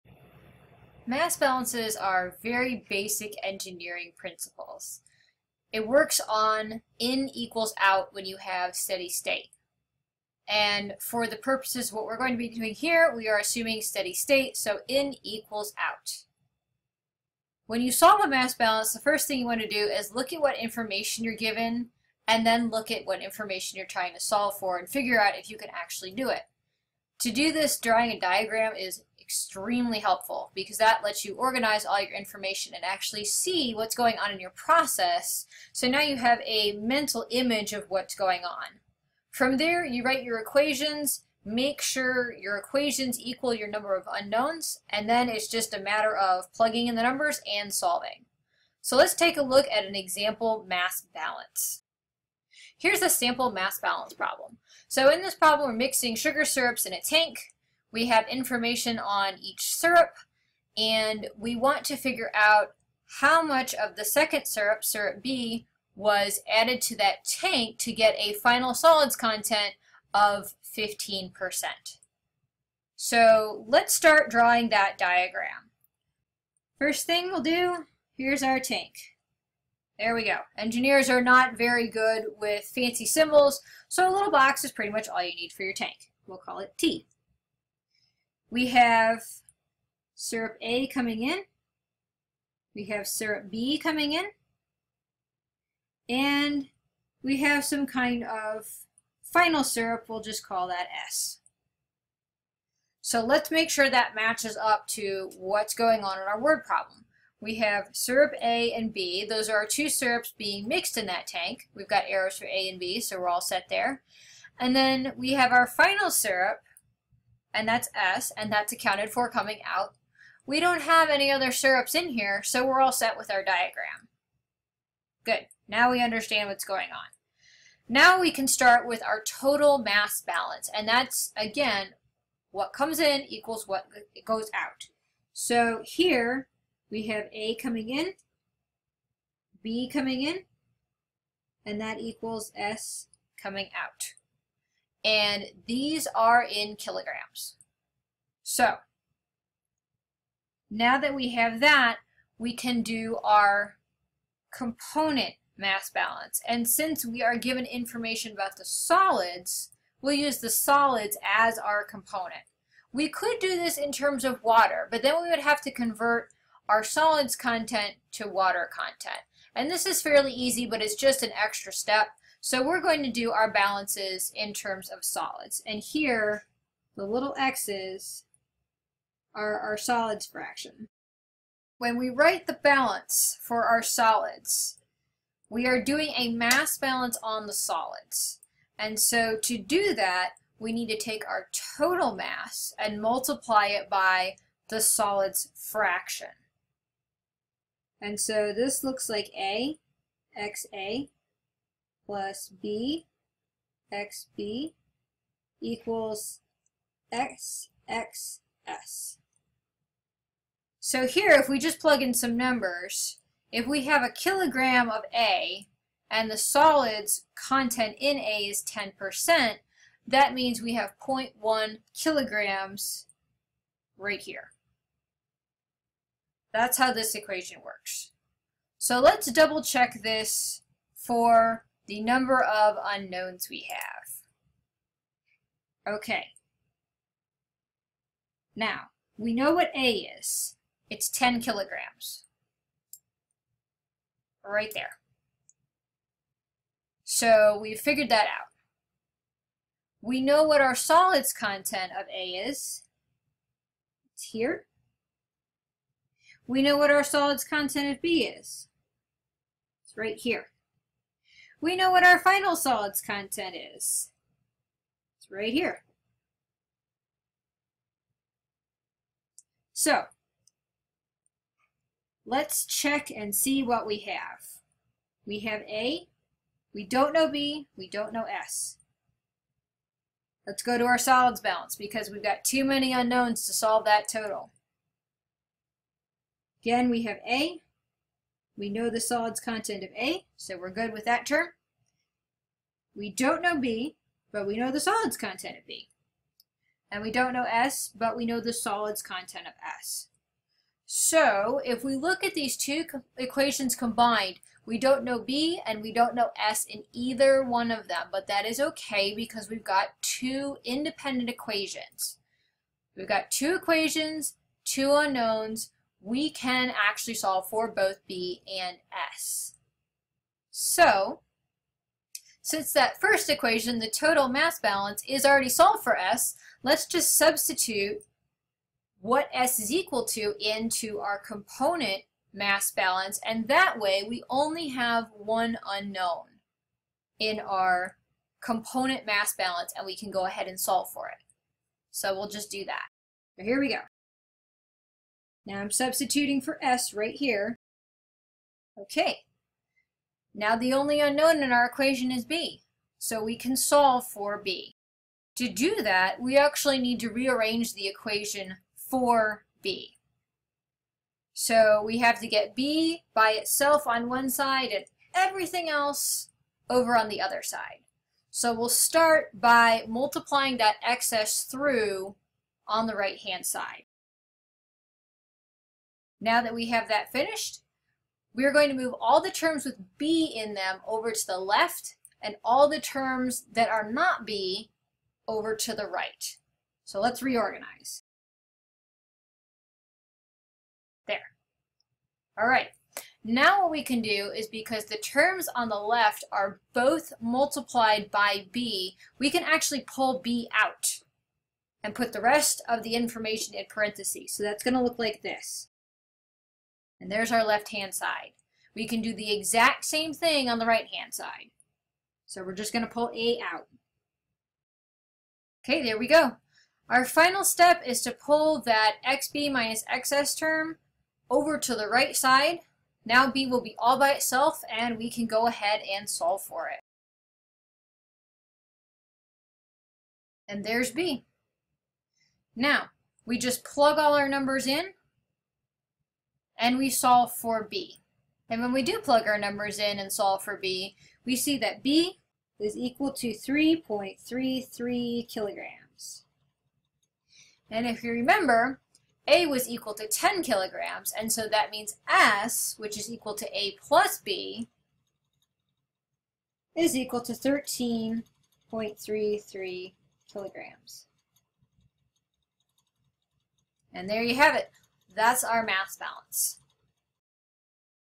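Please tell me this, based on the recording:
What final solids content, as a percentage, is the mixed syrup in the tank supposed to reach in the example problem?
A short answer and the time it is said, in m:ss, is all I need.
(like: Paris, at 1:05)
15%, at 1:10.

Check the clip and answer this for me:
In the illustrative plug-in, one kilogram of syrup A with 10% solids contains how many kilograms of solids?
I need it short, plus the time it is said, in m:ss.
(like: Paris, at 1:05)
0.1 kilograms, at 3:41.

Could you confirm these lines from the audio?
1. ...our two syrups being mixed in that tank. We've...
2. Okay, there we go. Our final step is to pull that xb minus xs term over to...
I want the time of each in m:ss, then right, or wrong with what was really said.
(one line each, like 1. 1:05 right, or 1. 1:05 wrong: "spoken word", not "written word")
1. 1:49 right
2. 6:55 right.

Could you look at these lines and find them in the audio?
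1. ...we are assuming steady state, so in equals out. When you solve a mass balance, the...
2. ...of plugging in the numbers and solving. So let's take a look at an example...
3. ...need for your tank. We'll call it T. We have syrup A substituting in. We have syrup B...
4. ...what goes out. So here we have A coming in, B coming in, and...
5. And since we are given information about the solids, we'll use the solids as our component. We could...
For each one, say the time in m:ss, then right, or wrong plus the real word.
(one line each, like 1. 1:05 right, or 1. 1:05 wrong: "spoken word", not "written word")
1. 0:13 right
2. 0:46 right
3. 1:25 wrong: "coming", not "substituting"
4. 2:13 right
5. 2:36 right.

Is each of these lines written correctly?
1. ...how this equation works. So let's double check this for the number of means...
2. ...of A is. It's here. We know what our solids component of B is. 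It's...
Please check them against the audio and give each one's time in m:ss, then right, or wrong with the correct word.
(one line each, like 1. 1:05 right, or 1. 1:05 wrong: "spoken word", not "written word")
1. 3:46 wrong: "unknowns", not "means"
2. 4:11 wrong: "content", not "component".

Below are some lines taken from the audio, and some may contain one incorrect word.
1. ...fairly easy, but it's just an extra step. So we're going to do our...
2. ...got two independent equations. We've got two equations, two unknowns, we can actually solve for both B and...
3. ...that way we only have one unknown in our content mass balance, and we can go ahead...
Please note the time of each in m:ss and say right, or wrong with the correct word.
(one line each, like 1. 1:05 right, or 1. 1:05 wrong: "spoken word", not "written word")
1. 2:50 right
2. 5:09 right
3. 5:33 wrong: "component", not "content".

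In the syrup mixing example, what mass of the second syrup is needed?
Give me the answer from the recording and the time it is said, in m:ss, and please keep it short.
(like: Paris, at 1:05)
3.33 kilograms, at 7:23.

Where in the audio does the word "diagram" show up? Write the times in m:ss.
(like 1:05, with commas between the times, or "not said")
0:28, 1:14, 2:03.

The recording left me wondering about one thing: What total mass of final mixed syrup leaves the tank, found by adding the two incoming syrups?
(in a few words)
13.33 kilograms.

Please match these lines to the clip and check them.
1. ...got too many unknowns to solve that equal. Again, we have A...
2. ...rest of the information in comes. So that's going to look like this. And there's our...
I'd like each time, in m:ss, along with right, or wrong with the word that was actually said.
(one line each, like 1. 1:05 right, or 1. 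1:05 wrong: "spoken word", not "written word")
1. 4:42 wrong: "total", not "equal"
2. 6:42 wrong: "parentheses", not "comes".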